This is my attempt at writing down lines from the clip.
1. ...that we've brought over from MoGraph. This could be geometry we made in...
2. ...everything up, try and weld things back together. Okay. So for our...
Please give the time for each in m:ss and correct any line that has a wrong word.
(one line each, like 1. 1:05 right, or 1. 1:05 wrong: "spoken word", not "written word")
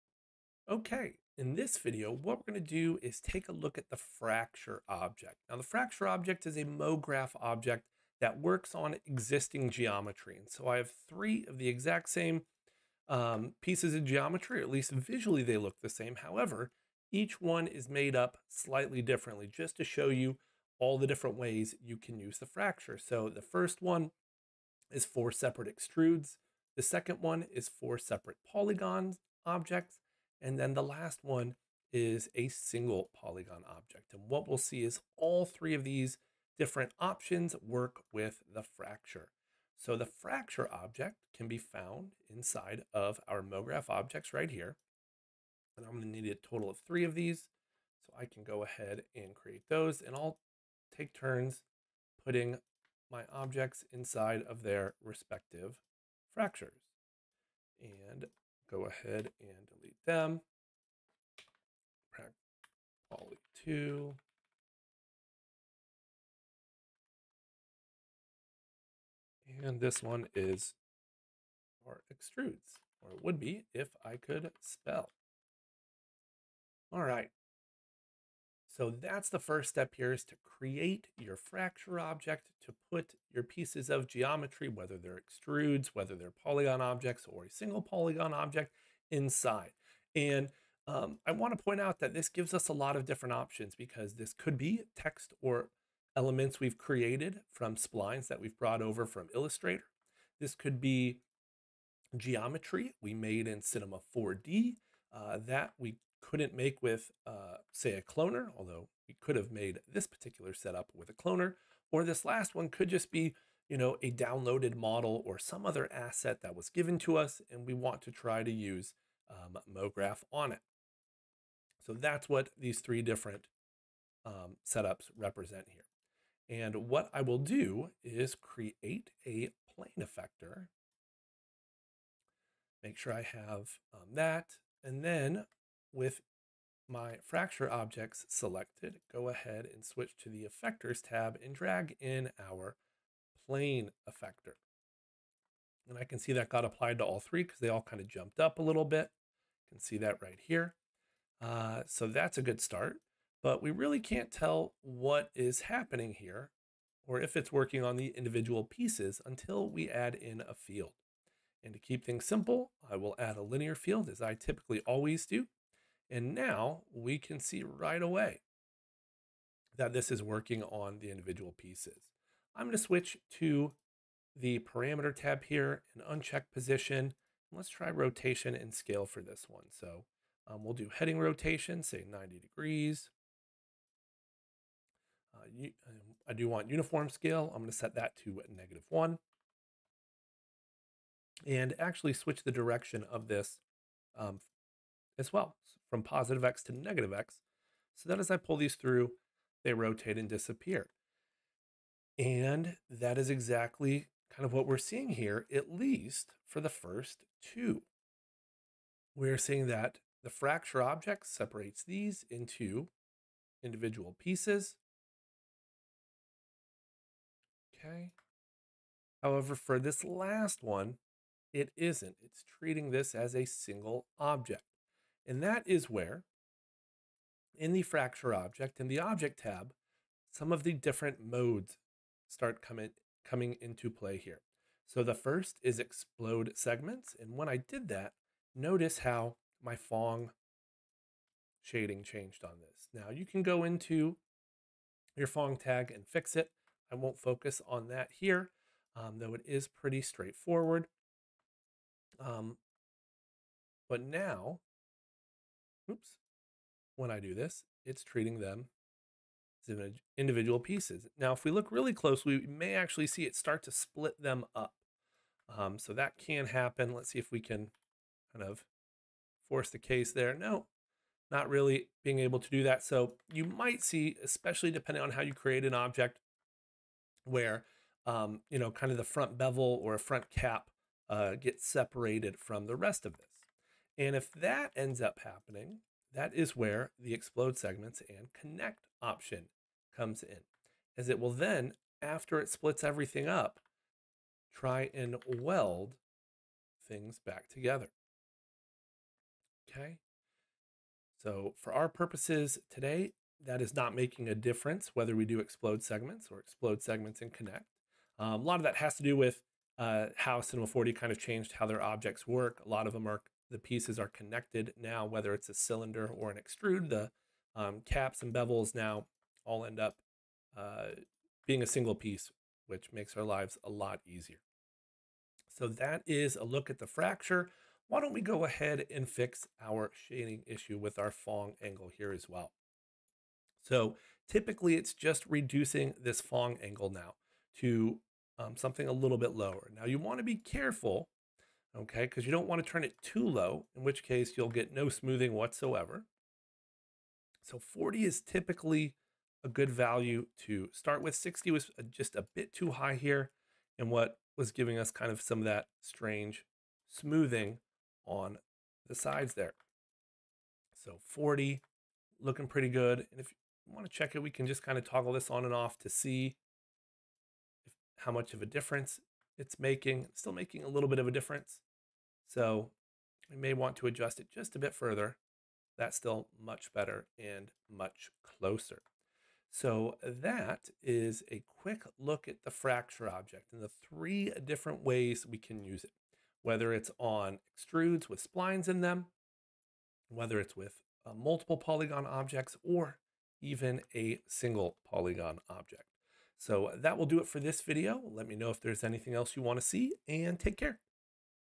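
1. 1:38 wrong: "Illustrator", not "MoGraph"
2. 4:52 right.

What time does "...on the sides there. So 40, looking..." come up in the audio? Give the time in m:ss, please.
5:58.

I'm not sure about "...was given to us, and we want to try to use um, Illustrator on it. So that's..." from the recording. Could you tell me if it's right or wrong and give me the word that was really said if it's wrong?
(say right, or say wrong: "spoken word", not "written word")
wrong: "MoGraph", not "Illustrator".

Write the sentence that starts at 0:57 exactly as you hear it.
And go ahead and delete them.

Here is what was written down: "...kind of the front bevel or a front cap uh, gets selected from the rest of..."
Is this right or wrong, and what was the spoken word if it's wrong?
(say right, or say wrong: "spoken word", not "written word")
wrong: "separated", not "selected".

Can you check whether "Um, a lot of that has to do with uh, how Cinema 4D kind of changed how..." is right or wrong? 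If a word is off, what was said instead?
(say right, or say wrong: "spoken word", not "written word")
right.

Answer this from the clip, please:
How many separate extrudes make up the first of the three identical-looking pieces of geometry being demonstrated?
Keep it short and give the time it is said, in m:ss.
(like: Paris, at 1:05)
4, at 0:25.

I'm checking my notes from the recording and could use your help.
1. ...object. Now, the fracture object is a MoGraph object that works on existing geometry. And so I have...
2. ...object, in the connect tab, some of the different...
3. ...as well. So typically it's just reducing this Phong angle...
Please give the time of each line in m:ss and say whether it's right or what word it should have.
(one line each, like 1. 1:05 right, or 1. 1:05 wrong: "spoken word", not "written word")
1. 0:04 right
2. 3:48 wrong: "object", not "connect"
3. 5:32 right.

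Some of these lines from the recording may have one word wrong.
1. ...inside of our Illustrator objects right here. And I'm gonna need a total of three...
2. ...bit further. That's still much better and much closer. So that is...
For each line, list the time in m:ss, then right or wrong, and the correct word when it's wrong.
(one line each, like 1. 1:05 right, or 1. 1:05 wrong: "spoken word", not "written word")
1. 0:42 wrong: "MoGraph", not "Illustrator"
2. 6:14 right.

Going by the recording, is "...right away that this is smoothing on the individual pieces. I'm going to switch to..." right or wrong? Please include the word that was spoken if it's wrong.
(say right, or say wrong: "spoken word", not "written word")
wrong: "working", not "smoothing".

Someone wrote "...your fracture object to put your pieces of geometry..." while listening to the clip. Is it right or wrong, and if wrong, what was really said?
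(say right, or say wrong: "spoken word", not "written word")
right.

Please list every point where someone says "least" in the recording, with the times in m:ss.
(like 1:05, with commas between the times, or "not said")
0:14, 3:25.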